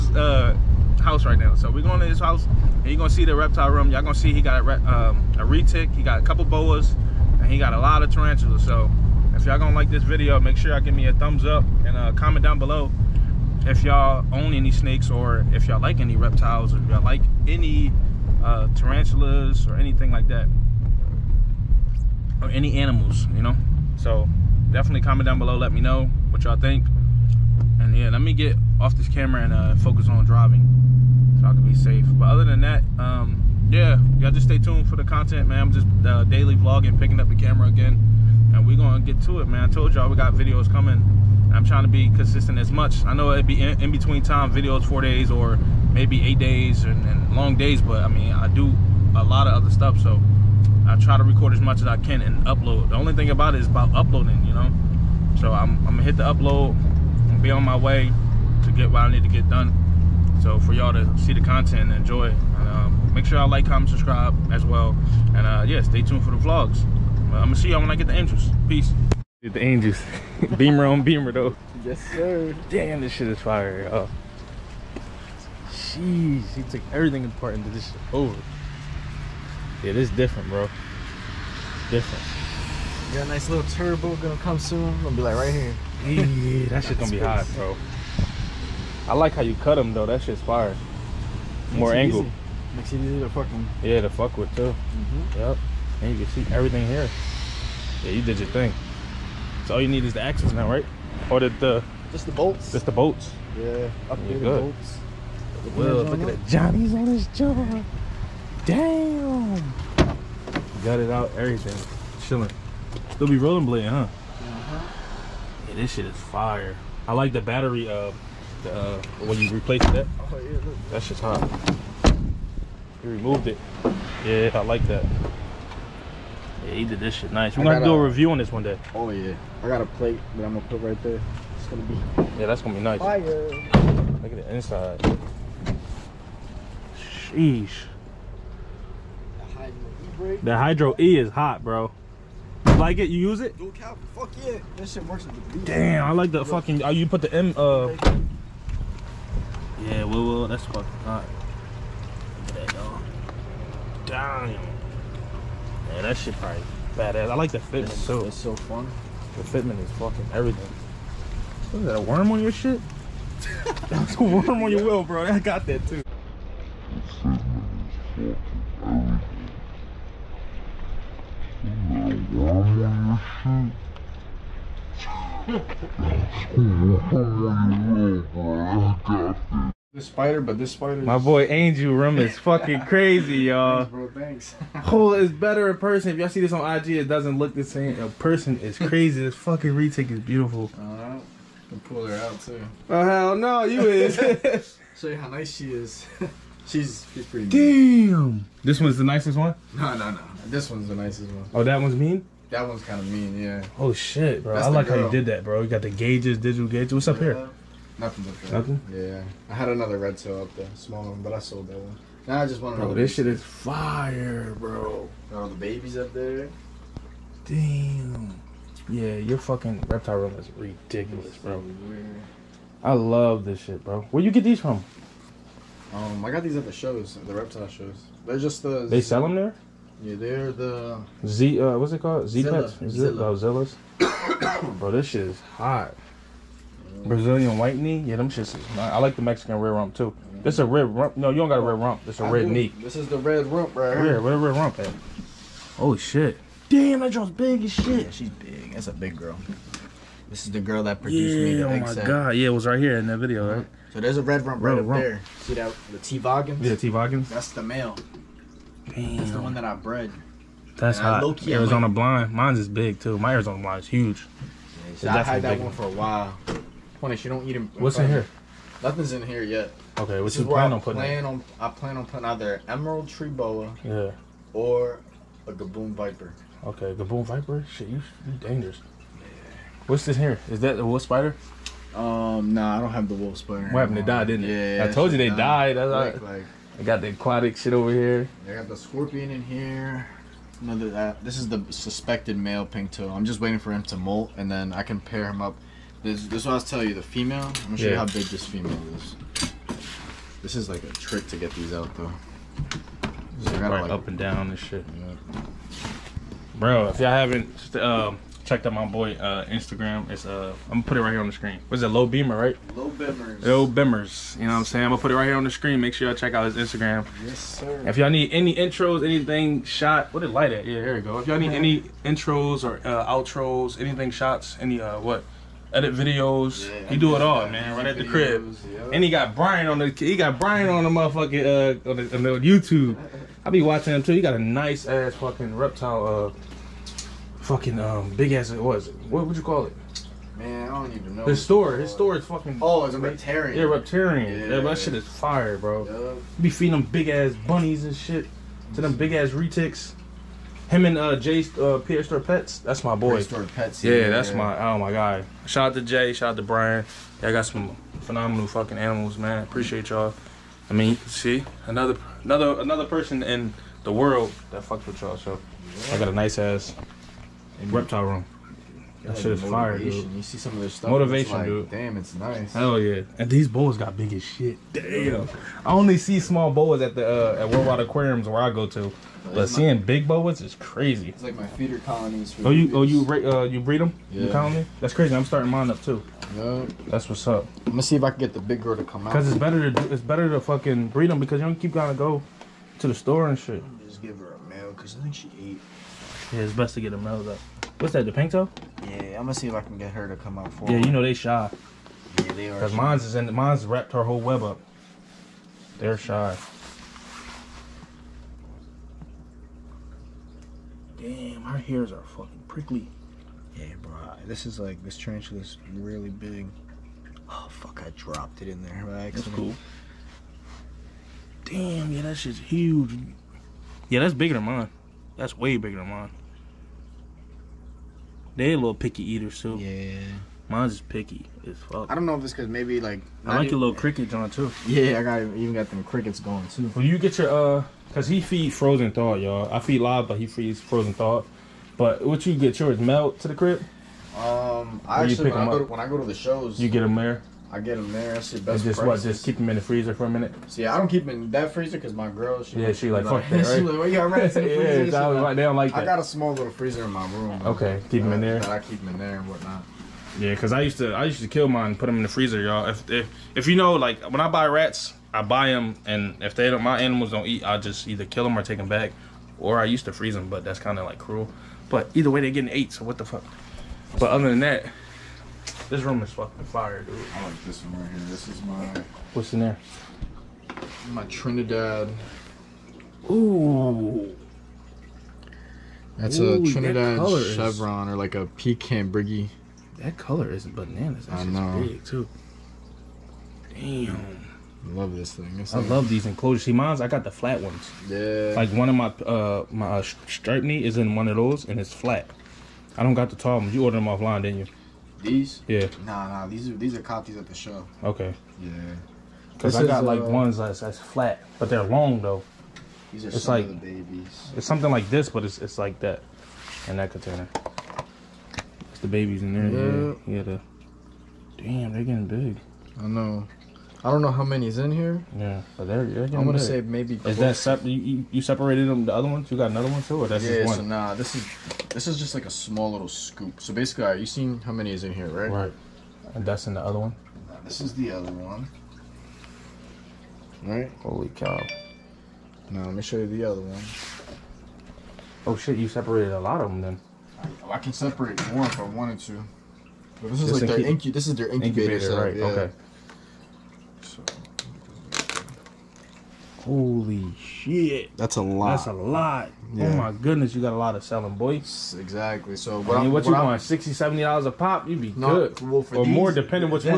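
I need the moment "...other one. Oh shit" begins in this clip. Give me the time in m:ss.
9:03.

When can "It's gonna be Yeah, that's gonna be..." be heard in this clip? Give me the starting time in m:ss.
2:11.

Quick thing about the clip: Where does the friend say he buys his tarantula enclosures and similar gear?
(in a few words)
reptile shows.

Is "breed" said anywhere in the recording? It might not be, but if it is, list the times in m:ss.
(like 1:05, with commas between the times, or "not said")
6:23, 6:30.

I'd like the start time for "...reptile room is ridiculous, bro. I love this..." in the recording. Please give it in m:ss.
3:39.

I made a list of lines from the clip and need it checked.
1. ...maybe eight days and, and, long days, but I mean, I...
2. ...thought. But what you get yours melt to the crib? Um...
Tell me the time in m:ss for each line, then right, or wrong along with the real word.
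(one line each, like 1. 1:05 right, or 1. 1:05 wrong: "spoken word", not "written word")
1. 0:45 right
2. 7:20 right.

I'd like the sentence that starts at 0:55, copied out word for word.
So I'm, I'm gonna hit the upload and be on my way to get what I need to get done.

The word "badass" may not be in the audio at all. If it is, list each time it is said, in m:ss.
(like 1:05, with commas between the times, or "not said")
2:36.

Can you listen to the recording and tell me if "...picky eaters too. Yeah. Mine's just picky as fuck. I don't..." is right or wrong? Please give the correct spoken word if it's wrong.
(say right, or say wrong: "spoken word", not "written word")
right.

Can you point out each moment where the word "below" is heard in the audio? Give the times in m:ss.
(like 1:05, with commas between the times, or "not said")
0:12, 0:25.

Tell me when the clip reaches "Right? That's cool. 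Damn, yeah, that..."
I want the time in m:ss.
6:58.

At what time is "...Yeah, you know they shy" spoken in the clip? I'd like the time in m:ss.
6:40.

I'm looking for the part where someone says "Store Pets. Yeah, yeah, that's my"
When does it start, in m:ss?
5:53.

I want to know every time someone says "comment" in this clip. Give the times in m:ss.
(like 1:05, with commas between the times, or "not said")
0:12, 0:25, 1:03.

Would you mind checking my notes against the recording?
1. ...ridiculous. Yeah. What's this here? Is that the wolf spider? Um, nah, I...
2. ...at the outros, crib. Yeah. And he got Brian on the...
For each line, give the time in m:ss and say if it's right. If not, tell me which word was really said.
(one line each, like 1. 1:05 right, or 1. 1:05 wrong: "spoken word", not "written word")
1. 4:38 wrong: "dangerous", not "ridiculous"
2. 5:27 wrong: "videos", not "outros".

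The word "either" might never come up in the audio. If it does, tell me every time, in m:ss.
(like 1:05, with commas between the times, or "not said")
4:32, 7:47, 7:51.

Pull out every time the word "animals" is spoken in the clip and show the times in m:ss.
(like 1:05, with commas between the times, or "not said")
0:22, 5:58, 7:46.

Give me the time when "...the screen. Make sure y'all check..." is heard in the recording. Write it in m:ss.
5:15.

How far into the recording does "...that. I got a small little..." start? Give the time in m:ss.
7:35.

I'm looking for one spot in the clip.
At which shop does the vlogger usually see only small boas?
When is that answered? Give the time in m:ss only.
6:17.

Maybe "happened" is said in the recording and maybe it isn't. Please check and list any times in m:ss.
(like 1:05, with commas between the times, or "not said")
4:43.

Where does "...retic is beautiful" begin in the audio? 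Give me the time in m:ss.
3:09.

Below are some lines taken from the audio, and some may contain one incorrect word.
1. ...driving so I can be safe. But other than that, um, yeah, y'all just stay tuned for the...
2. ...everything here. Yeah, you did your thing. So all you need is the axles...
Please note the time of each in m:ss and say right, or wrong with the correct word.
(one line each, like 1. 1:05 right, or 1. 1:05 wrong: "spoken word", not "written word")
1. 0:30 right
2. 1:36 right.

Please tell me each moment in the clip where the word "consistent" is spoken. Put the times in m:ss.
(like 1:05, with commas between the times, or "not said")
0:42.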